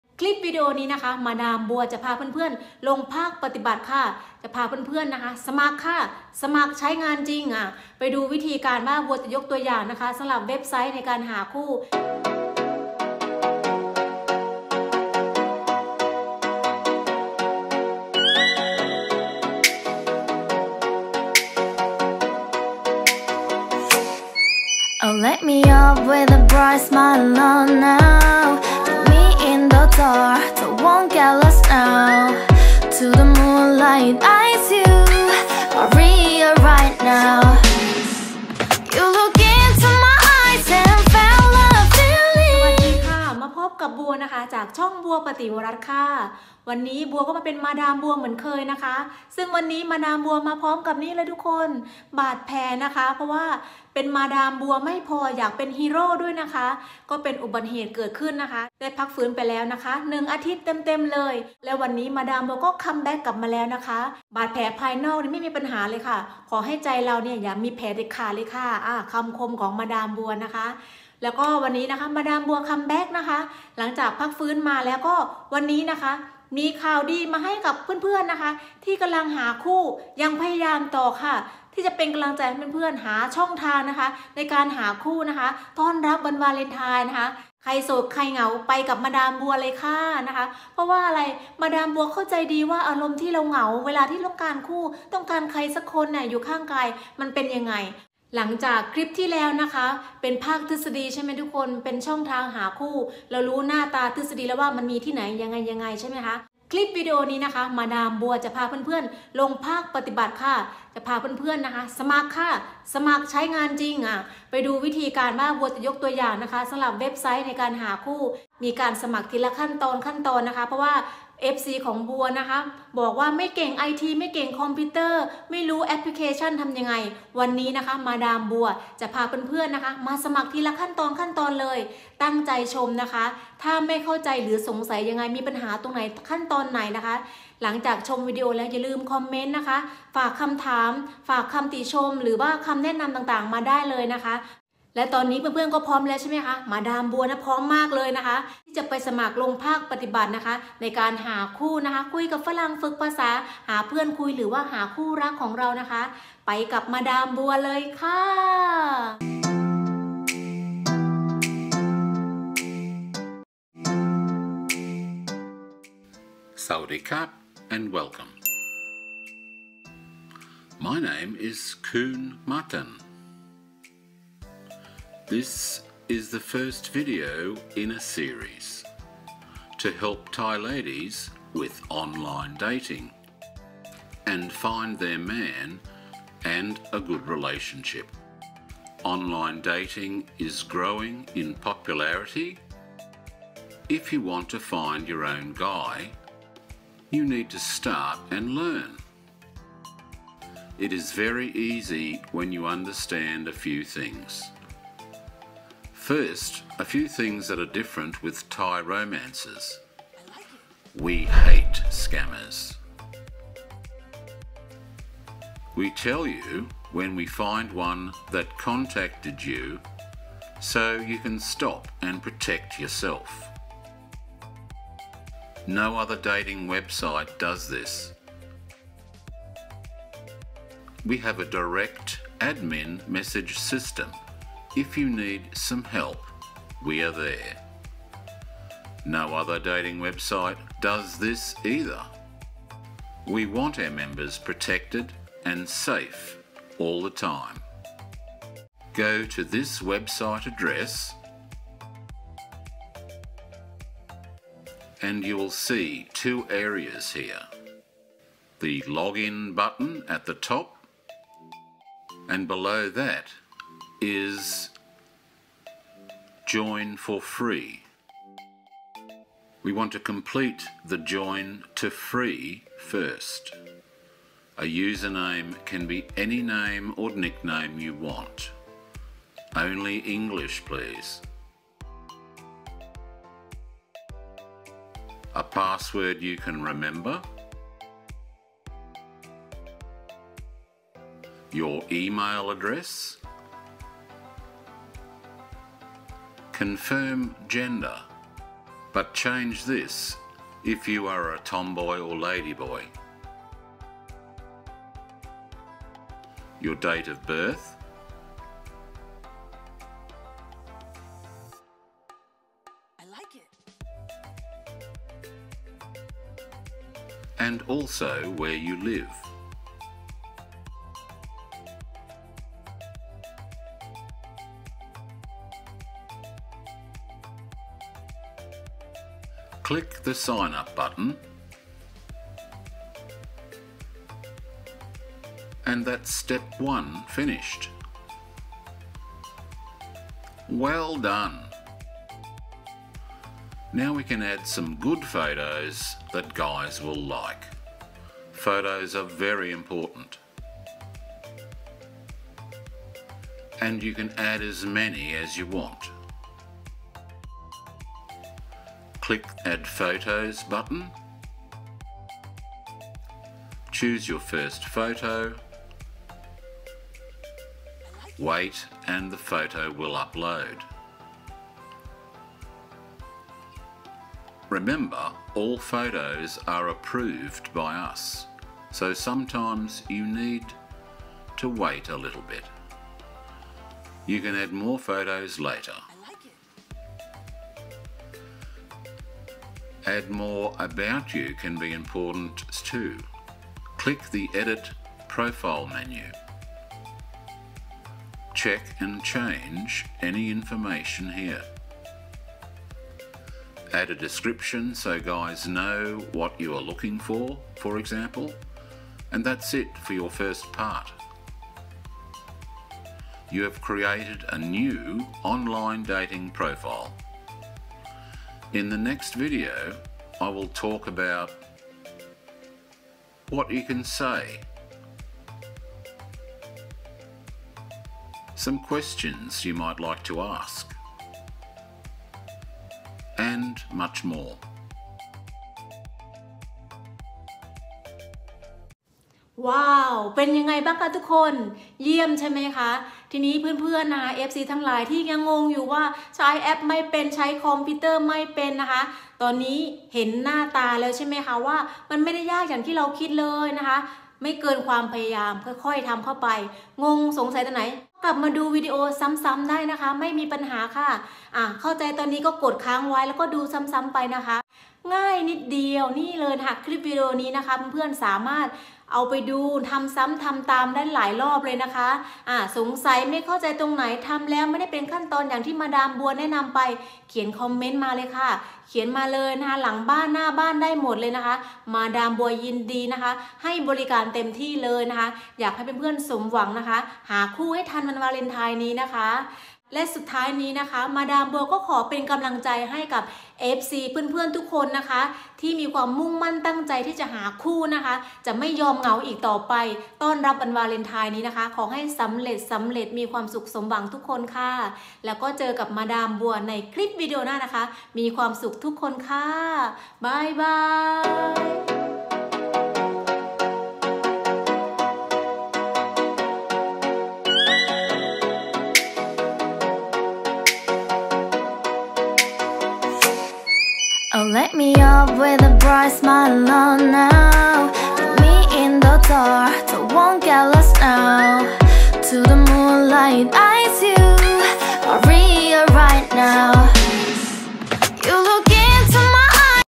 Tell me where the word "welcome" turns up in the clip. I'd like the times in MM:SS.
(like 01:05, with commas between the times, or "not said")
02:47.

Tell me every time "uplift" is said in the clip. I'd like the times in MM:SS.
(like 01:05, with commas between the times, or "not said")
not said.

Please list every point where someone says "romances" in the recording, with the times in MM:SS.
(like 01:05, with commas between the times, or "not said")
03:28.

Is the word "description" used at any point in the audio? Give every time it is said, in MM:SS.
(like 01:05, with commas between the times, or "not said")
06:43.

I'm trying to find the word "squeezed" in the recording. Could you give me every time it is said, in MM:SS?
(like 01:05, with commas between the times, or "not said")
not said.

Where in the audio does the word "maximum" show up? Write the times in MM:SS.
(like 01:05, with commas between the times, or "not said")
not said.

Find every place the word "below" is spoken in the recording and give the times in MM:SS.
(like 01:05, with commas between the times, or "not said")
04:22.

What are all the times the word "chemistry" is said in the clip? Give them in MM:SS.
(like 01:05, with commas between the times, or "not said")
not said.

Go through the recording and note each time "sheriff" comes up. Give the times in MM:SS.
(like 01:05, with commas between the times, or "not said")
not said.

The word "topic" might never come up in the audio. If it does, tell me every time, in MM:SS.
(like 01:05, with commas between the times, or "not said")
not said.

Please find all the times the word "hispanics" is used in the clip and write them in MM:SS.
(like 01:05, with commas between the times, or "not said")
not said.